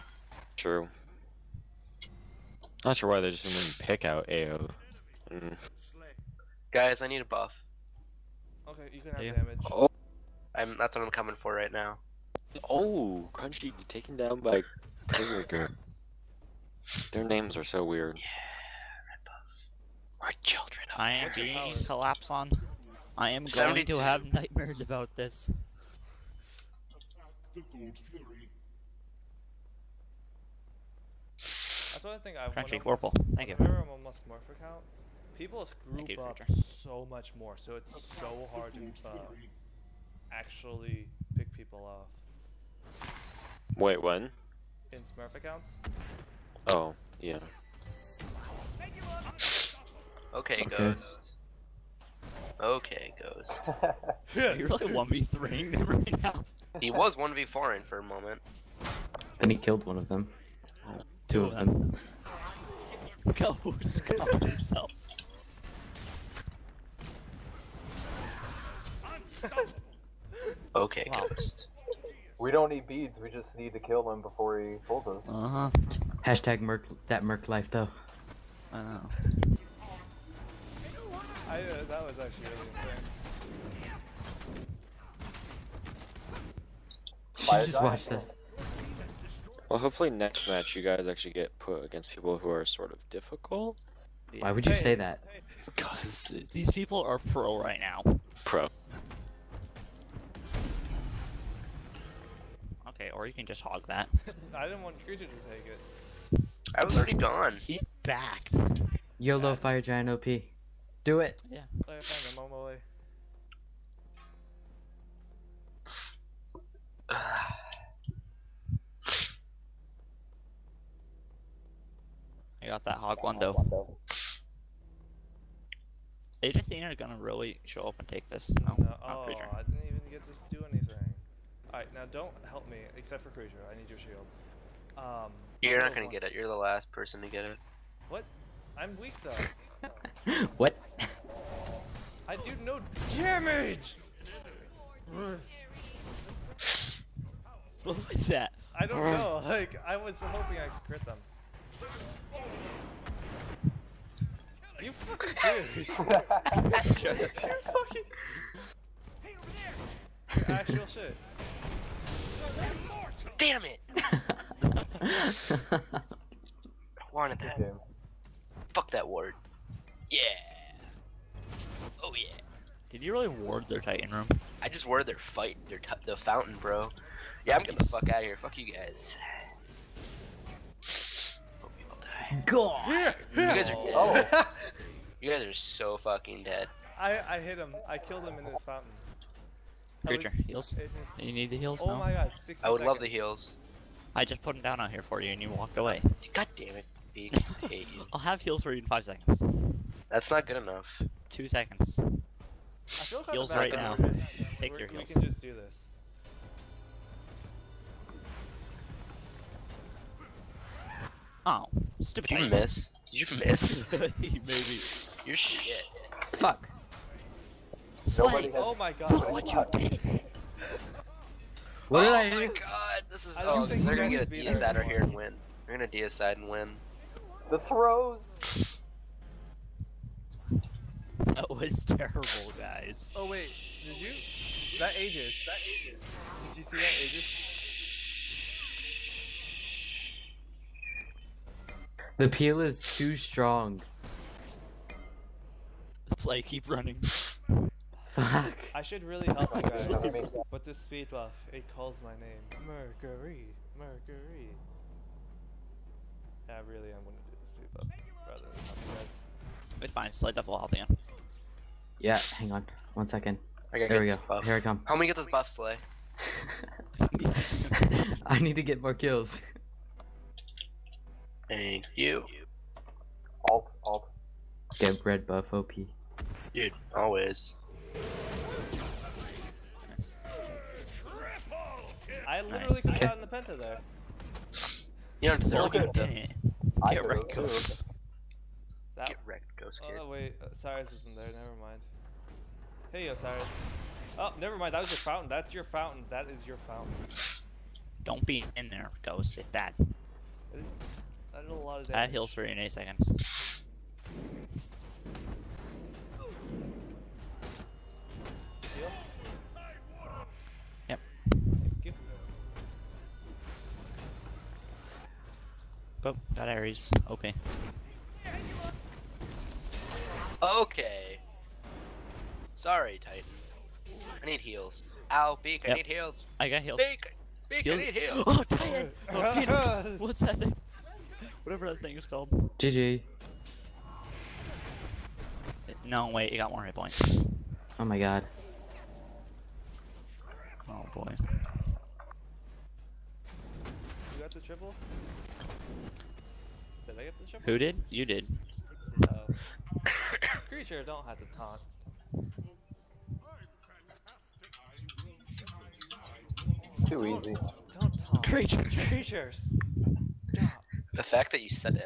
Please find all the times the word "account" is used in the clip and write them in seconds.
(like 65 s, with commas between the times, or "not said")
33 s, 45 s.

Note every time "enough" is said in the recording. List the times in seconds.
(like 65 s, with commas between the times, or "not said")
200 s.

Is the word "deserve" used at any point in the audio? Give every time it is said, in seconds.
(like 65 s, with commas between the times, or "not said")
285 s.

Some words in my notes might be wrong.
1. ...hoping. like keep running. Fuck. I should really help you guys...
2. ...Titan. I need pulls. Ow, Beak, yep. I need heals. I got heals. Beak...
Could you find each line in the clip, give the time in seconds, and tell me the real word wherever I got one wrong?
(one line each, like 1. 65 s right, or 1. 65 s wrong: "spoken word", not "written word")
1. 243 s wrong: "strong", not "hoping"
2. 323 s wrong: "heals", not "pulls".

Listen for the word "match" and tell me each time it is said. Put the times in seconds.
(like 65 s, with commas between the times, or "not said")
90 s.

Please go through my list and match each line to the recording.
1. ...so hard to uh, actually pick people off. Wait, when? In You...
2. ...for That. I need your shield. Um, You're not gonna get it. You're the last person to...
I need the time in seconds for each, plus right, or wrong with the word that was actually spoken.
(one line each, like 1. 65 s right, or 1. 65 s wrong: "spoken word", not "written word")
1. 38 s wrong: "Smurf", not "You"
2. 133 s wrong: "Creature", not "That".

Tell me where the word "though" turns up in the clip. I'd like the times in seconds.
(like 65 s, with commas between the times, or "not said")
77 s, 139 s.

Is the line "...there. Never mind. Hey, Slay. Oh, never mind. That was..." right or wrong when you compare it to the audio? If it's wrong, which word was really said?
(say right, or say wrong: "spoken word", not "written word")
wrong: "Osiris", not "Slay".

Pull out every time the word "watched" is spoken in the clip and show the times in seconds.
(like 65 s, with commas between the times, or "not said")
87 s.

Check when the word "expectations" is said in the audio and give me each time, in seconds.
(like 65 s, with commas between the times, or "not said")
not said.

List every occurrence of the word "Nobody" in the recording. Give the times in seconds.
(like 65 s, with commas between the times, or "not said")
218 s.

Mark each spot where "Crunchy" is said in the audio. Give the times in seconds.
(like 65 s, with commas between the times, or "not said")
13 s, 32 s.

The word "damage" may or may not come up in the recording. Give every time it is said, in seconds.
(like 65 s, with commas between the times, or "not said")
9 s, 143 s, 301 s.